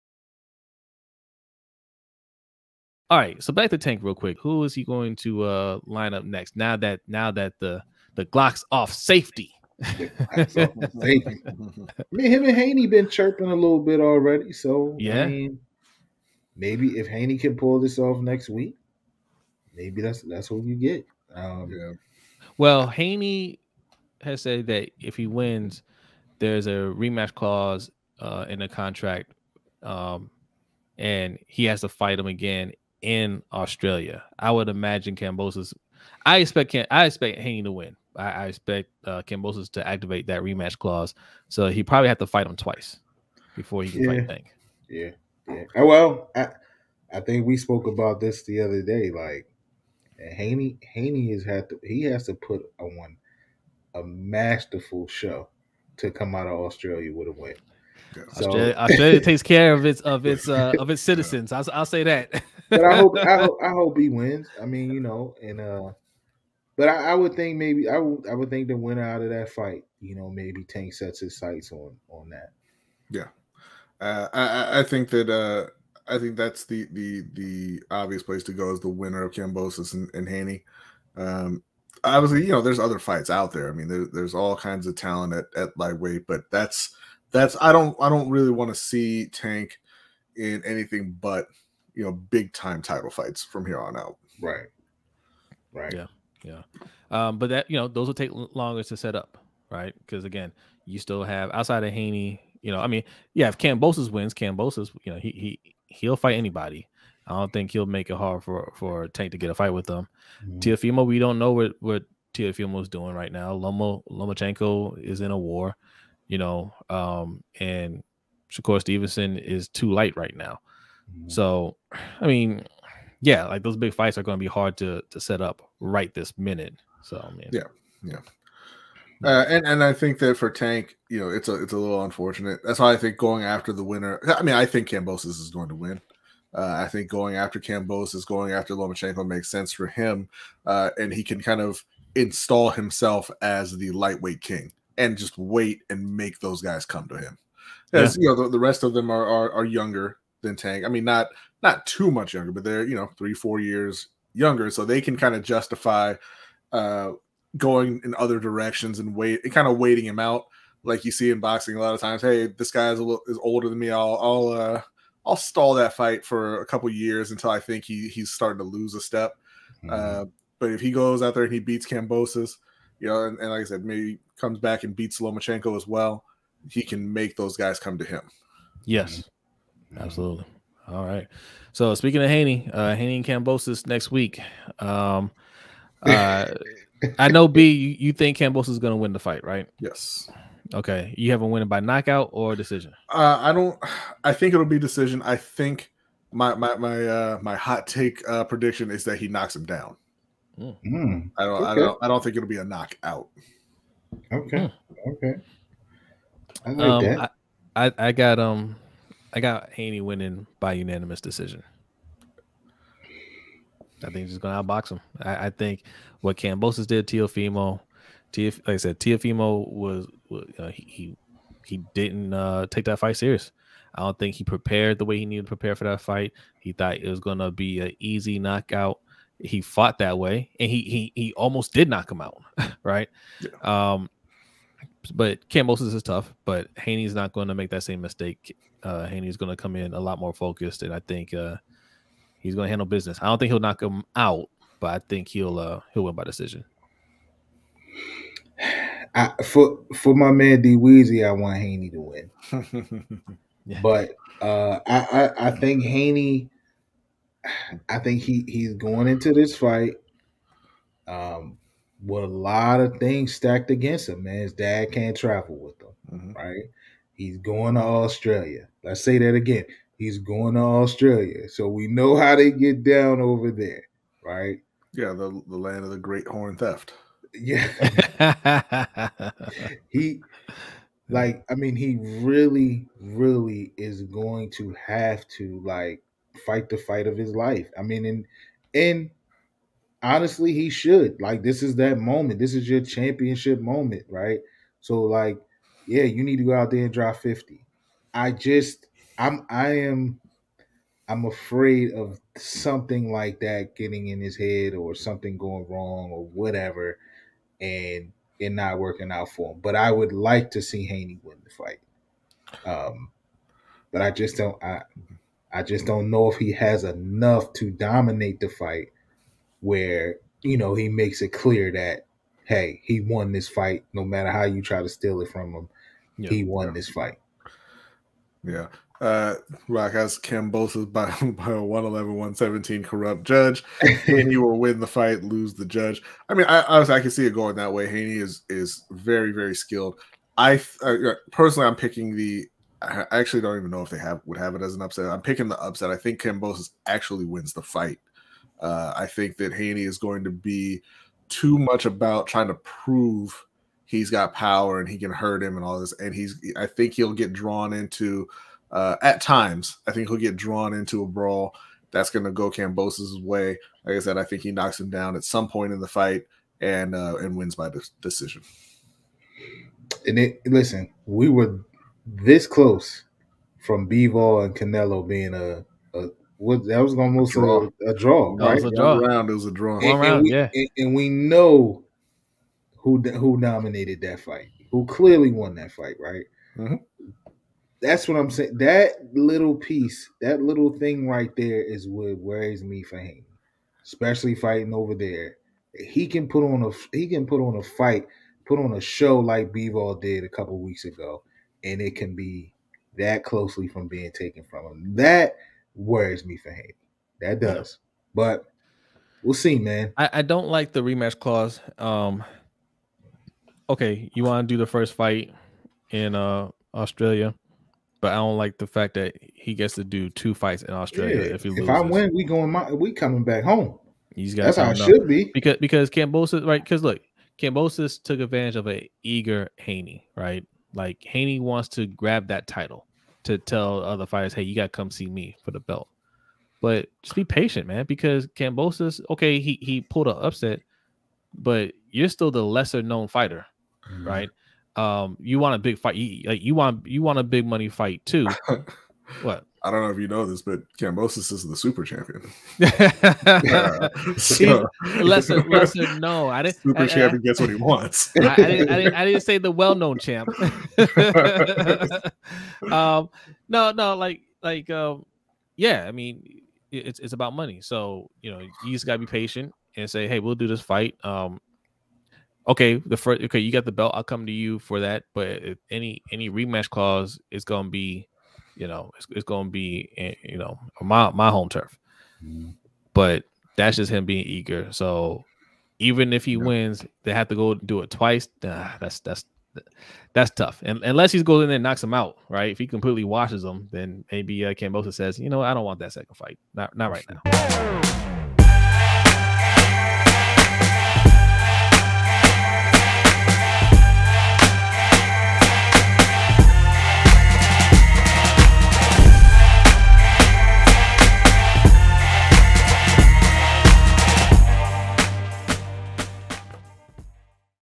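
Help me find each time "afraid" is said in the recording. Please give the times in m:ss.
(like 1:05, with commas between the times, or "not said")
5:01.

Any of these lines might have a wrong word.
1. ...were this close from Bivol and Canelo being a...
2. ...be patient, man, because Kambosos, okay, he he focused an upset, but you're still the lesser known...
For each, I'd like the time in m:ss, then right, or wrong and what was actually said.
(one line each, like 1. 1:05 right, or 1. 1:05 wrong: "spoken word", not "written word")
1. 6:11 right
2. 7:17 wrong: "pulled", not "focused".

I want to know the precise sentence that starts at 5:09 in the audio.
But I would like to see Haney win the fight.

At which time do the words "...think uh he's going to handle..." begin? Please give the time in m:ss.
4:00.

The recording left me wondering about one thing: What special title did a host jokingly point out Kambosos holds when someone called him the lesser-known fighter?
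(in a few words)
Super champion.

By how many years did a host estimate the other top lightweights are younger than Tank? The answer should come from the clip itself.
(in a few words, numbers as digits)
3 or 4 years.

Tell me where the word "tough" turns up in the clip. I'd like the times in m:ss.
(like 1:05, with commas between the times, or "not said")
3:56, 8:10.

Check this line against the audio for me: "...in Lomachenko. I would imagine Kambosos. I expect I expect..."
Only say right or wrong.
wrong.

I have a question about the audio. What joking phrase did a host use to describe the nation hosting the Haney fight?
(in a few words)
The great horn theft.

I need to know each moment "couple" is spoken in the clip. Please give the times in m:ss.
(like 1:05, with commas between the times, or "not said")
2:46, 6:40.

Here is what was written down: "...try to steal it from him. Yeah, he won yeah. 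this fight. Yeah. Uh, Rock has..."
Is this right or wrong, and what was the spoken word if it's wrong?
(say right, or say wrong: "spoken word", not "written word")
right.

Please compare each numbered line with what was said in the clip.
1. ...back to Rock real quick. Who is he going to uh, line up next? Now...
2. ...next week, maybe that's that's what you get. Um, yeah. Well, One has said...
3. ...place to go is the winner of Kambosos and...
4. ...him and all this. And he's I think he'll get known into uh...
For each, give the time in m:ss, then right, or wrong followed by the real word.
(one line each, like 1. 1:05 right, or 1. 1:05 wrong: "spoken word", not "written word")
1. 0:03 wrong: "Tank", not "Rock"
2. 0:18 wrong: "Haney", not "One"
3. 1:18 right
4. 5:55 wrong: "drawn", not "known".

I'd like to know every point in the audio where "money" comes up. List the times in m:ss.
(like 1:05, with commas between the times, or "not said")
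7:27, 7:47.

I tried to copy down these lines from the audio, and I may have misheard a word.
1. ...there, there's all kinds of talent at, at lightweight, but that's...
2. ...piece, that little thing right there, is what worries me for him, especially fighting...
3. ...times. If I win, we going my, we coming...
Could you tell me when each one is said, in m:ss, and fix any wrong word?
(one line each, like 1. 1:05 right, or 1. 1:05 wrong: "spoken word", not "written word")
1. 1:23 right
2. 6:29 right
3. 7:01 wrong: "loses", not "times".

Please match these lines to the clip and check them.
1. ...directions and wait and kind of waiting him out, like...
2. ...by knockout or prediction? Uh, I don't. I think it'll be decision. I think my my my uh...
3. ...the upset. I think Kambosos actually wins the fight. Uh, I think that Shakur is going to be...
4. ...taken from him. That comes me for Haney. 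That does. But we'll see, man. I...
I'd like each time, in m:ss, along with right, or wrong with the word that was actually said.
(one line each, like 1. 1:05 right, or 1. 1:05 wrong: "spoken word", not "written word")
1. 2:38 right
2. 3:11 wrong: "decision", not "prediction"
3. 5:45 wrong: "Haney", not "Shakur"
4. 6:44 wrong: "worries", not "comes".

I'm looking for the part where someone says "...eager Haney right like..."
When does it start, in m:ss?
7:09.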